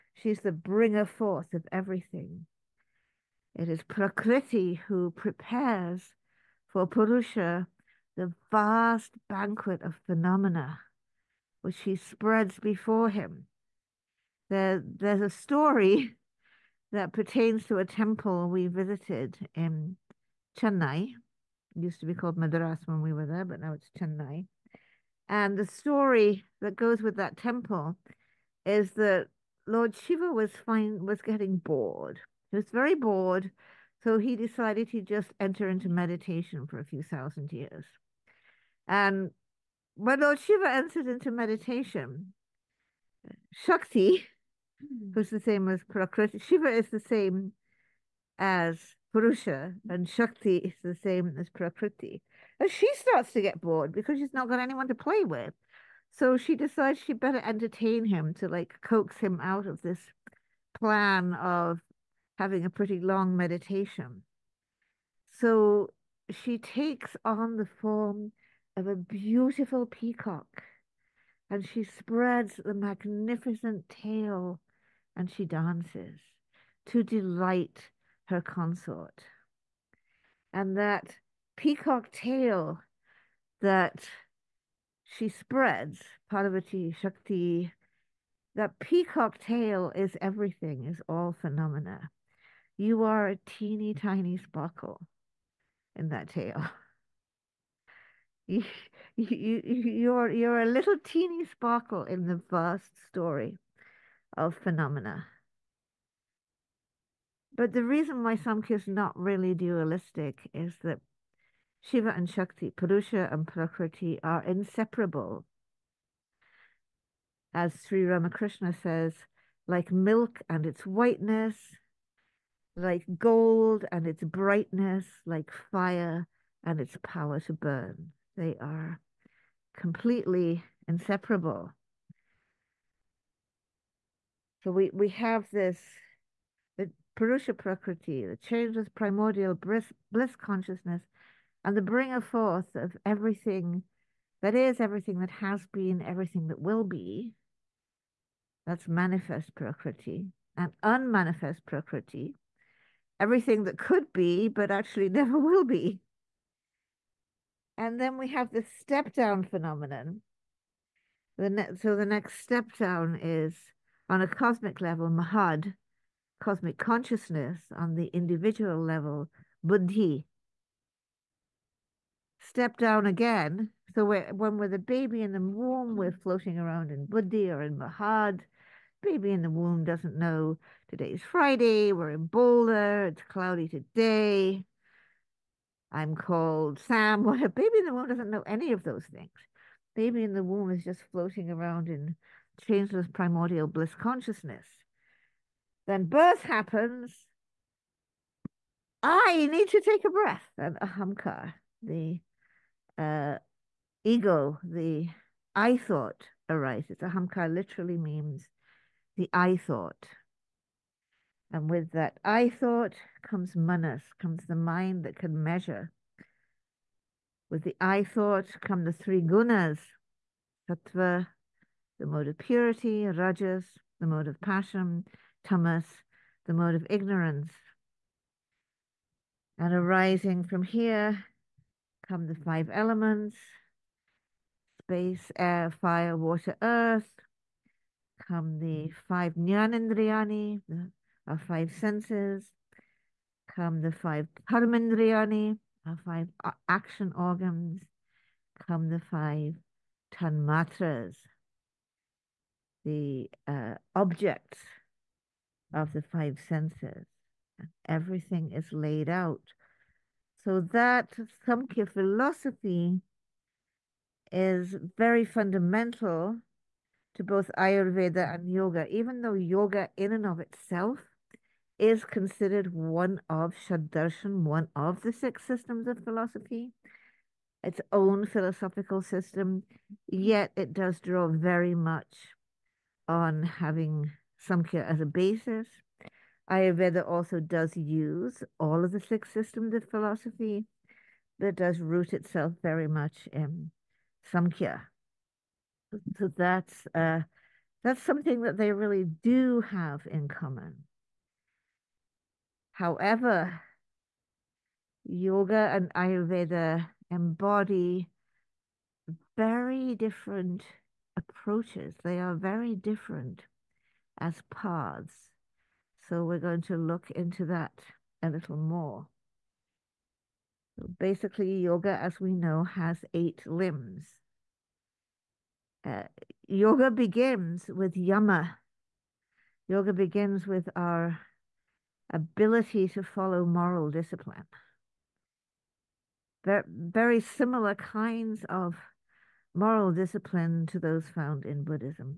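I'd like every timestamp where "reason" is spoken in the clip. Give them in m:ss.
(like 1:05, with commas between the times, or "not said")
1:47.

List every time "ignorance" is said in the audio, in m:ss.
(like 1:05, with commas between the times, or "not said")
3:46.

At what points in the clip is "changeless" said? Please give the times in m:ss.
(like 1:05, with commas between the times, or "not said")
2:18, 3:12.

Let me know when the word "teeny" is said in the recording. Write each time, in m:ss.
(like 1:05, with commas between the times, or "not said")
1:33, 1:41.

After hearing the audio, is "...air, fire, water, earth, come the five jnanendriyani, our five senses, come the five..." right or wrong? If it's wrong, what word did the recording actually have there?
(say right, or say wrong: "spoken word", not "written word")
right.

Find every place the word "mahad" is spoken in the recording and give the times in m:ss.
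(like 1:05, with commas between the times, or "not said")
2:45, 2:57.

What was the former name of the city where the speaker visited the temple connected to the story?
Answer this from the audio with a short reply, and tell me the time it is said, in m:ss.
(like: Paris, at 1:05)
Madras, at 0:22.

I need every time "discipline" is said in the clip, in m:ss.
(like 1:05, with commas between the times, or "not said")
5:33, 5:39.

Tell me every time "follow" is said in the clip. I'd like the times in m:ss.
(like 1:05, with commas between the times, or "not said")
5:33.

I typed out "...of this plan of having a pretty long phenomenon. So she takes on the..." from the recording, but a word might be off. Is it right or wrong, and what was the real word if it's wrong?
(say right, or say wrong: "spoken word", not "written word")
wrong: "meditation", not "phenomenon".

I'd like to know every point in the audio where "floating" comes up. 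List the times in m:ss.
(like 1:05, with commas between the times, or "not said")
2:56, 3:11.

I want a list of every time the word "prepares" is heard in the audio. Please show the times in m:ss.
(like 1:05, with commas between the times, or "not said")
0:05.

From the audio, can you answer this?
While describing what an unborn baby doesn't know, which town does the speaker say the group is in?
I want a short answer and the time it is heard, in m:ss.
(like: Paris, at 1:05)
Boulder, at 3:02.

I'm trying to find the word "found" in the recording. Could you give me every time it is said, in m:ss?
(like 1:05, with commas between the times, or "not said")
5:41.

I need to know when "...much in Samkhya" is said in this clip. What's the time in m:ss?
4:52.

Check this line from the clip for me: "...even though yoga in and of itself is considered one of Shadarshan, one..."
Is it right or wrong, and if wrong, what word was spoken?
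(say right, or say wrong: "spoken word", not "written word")
right.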